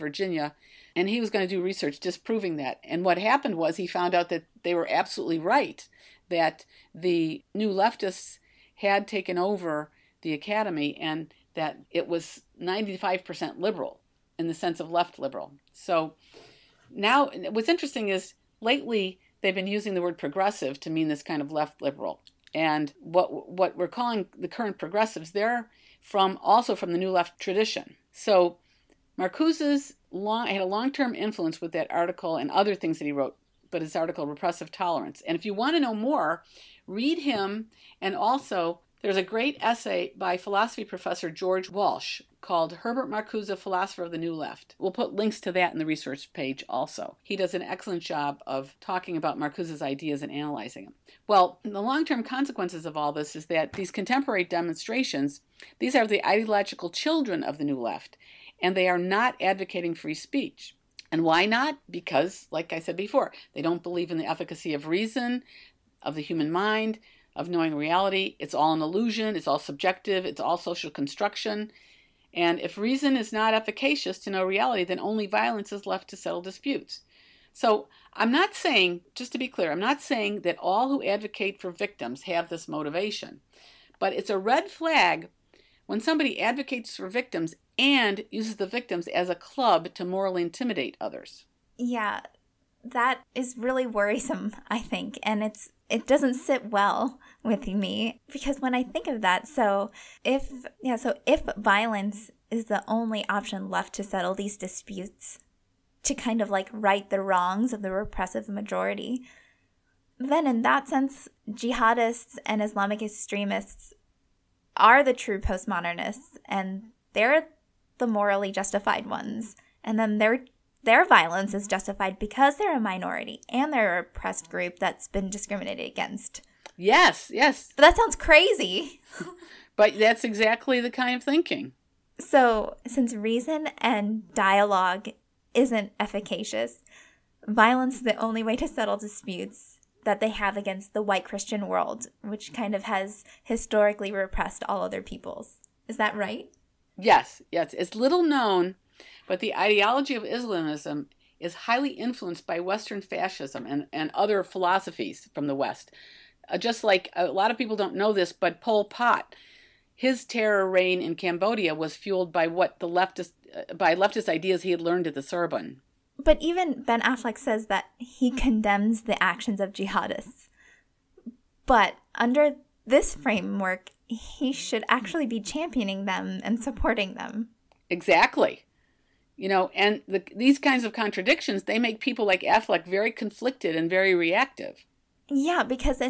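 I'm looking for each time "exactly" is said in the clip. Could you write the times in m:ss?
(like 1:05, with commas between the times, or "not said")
2:10, 2:57.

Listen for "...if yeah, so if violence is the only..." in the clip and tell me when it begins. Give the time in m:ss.
1:40.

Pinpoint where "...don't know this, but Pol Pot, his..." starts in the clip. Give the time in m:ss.
2:37.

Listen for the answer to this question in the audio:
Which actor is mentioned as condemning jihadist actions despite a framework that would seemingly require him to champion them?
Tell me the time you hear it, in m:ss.
2:46.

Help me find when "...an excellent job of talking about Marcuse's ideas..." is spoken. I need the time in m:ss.
0:47.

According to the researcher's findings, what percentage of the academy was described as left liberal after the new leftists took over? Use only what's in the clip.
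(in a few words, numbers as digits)
95%.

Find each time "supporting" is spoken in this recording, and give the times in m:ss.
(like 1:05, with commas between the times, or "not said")
2:56.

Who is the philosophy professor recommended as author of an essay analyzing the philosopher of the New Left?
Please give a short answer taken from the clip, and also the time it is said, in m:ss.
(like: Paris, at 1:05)
George Walsh, at 0:41.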